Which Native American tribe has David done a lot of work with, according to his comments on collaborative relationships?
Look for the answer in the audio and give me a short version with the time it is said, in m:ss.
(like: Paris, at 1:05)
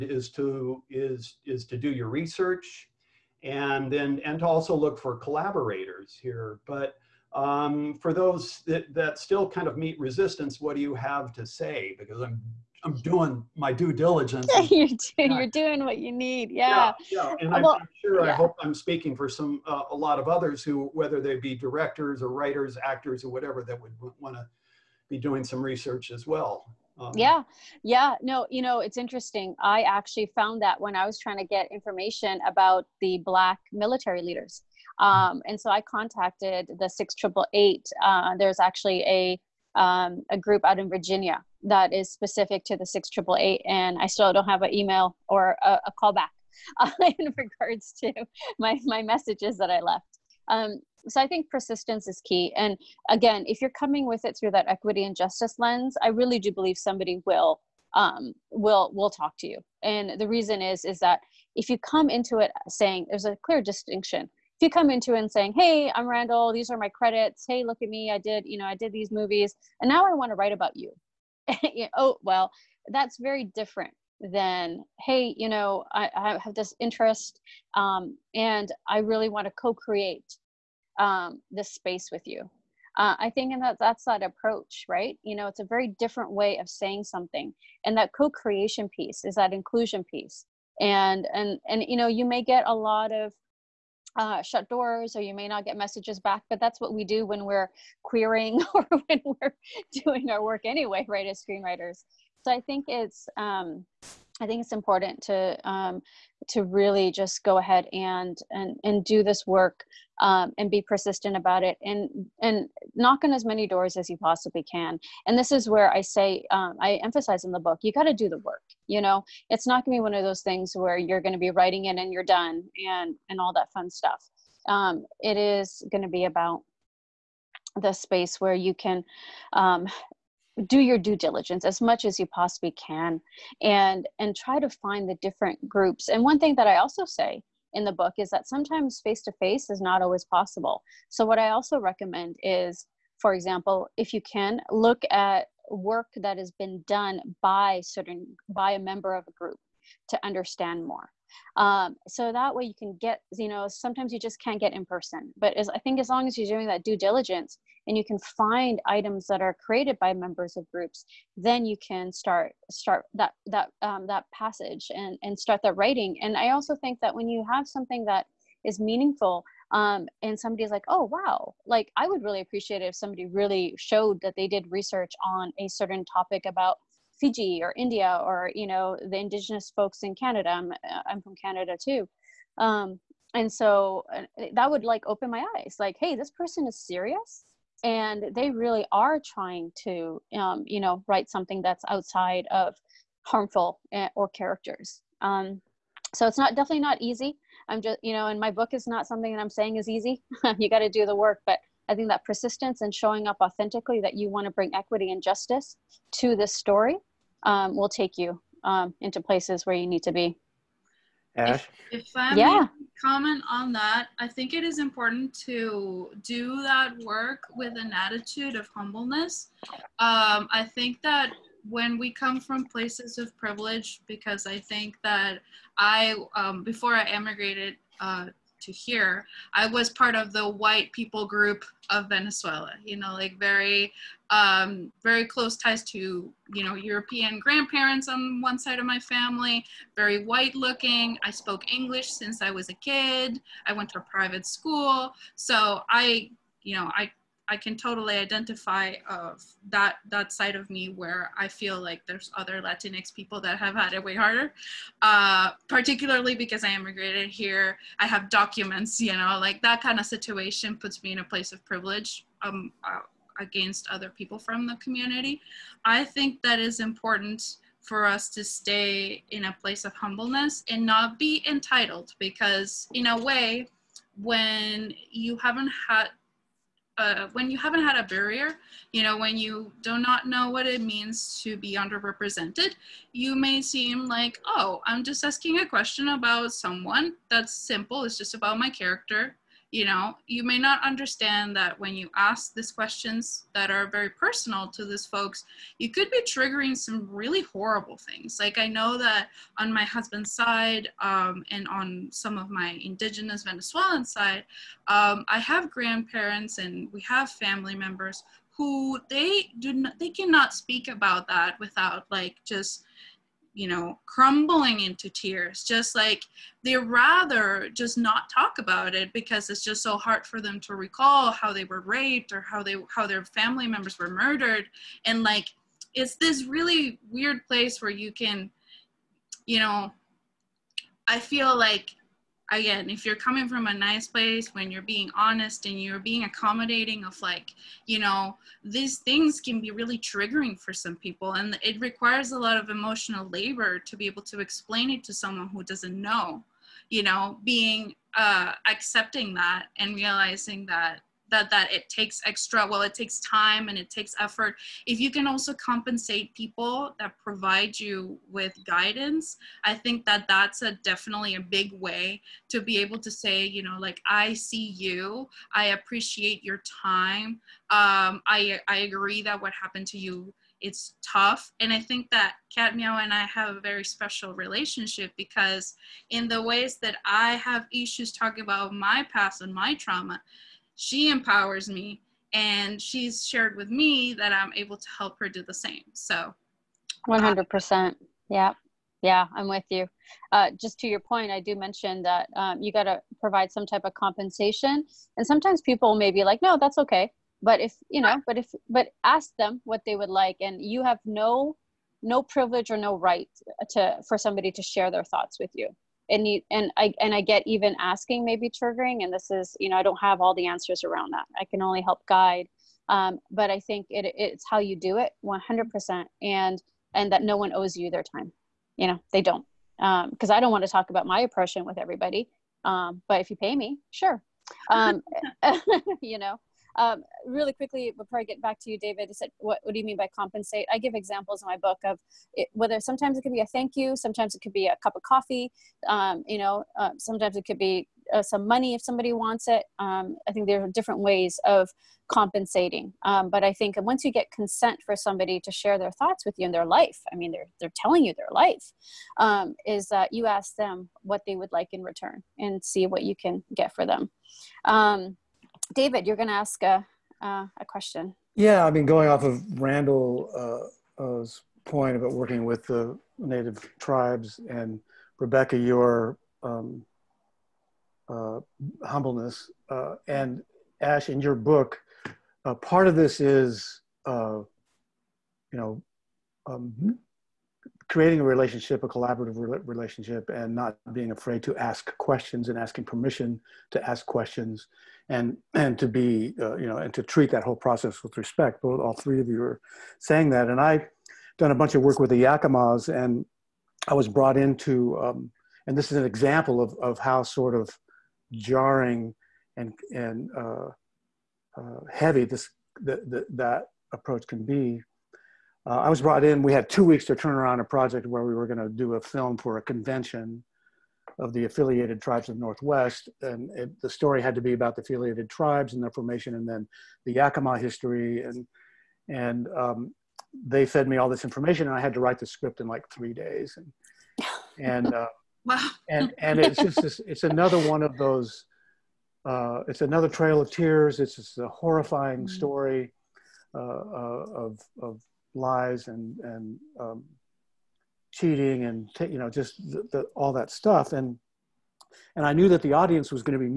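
Yakimas, at 8:12.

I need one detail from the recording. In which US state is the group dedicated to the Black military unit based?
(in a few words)
Virginia.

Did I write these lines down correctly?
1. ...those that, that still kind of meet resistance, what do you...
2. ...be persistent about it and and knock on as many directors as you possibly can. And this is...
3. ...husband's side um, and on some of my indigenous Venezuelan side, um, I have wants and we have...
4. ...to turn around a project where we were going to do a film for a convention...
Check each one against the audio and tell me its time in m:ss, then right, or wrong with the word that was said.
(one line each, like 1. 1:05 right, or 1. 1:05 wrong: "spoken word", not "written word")
1. 0:08 right
2. 1:50 wrong: "doors", not "directors"
3. 4:59 wrong: "grandparents", not "wants"
4. 8:27 right.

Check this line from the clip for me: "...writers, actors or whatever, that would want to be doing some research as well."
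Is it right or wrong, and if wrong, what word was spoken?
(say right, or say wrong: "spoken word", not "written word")
right.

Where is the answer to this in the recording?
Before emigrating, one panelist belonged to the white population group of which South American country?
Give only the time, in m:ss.
3:52.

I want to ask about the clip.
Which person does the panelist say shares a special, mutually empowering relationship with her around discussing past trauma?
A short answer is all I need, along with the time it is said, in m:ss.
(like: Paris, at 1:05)
KatMeow, at 6:12.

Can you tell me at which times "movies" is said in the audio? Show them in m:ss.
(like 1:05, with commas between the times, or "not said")
1:09.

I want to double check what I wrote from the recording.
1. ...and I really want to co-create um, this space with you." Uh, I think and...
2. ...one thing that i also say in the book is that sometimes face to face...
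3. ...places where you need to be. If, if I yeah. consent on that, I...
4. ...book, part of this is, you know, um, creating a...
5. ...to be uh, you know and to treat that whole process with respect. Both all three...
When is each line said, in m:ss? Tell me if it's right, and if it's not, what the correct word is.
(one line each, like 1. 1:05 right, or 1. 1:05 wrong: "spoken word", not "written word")
1. 1:18 right
2. 2:16 right
3. 3:29 wrong: "comment", not "consent"
4. 7:51 right
5. 8:05 right.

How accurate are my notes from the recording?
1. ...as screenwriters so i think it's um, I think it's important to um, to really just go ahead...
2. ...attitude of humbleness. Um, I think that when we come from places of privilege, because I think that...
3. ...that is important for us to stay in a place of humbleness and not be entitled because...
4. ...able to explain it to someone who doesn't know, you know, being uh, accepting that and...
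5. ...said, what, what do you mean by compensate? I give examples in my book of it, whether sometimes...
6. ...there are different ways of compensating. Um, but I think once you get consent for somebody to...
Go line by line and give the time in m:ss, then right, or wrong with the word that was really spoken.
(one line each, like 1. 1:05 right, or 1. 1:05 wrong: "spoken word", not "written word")
1. 1:41 right
2. 3:37 right
3. 4:26 right
4. 5:44 right
5. 7:09 right
6. 7:20 right.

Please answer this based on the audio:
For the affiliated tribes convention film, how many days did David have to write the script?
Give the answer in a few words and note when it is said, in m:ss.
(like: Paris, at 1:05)
3 days, at 8:42.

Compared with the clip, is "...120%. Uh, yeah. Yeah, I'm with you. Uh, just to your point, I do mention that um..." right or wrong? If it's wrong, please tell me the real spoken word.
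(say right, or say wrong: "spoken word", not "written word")
wrong: "100", not "120".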